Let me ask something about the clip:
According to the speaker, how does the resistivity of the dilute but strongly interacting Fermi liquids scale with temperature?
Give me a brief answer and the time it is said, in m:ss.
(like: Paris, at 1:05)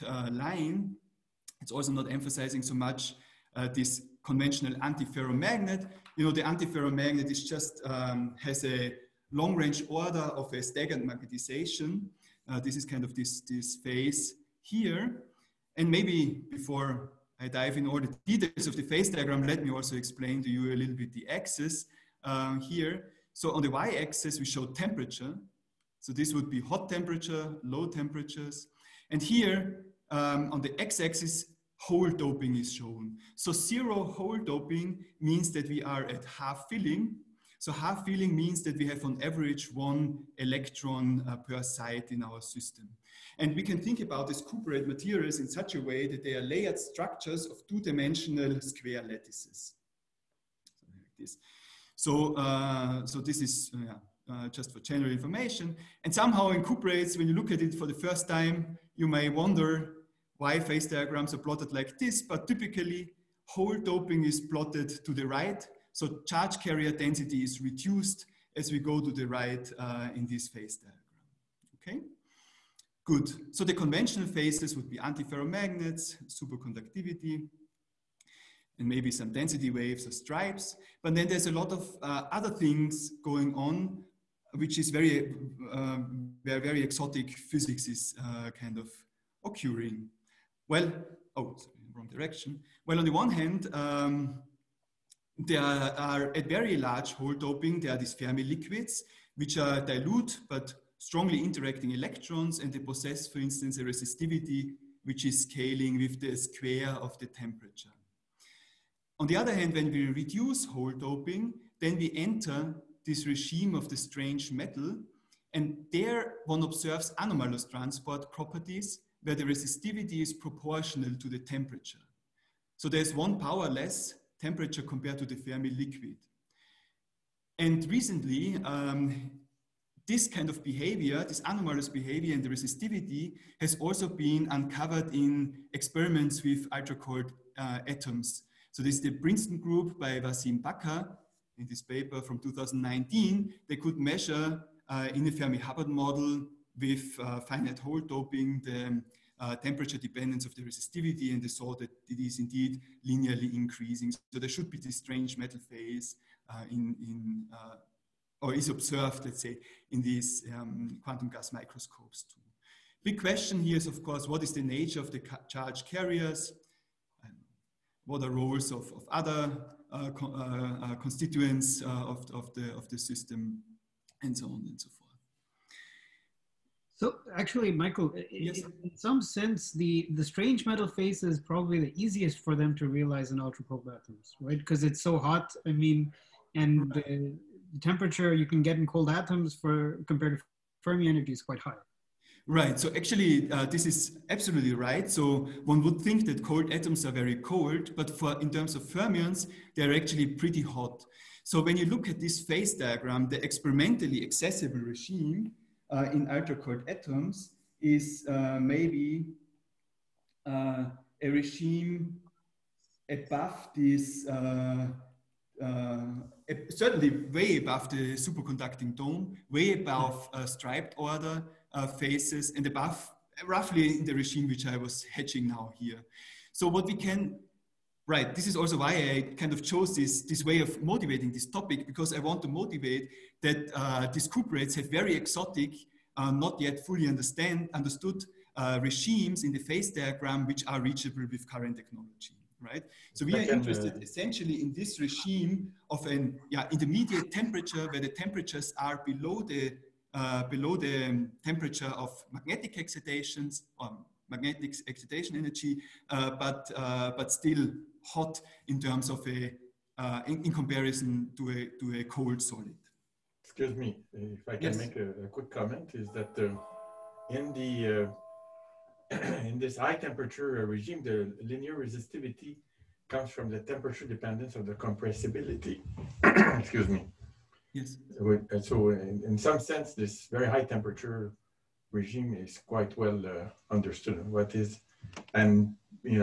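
Square of the temperature, at 1:46.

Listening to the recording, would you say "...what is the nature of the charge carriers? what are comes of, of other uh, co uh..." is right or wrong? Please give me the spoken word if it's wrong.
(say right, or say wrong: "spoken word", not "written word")
wrong: "roles", not "comes".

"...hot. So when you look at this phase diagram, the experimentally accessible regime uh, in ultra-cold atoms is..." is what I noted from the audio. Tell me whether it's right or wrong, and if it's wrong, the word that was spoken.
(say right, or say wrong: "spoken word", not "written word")
right.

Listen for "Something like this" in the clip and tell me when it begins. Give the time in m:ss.
0:50.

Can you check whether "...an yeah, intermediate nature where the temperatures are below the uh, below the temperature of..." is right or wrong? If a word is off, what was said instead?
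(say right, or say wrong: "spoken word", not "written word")
wrong: "temperature", not "nature".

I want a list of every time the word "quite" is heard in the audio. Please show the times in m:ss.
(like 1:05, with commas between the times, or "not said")
3:11, 4:42.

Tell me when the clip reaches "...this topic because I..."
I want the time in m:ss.
3:51.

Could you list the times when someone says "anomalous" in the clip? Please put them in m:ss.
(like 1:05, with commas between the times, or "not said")
1:57, 2:11.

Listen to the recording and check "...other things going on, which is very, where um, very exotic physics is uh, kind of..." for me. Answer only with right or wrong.
right.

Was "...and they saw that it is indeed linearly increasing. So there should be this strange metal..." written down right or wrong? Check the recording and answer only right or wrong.
right.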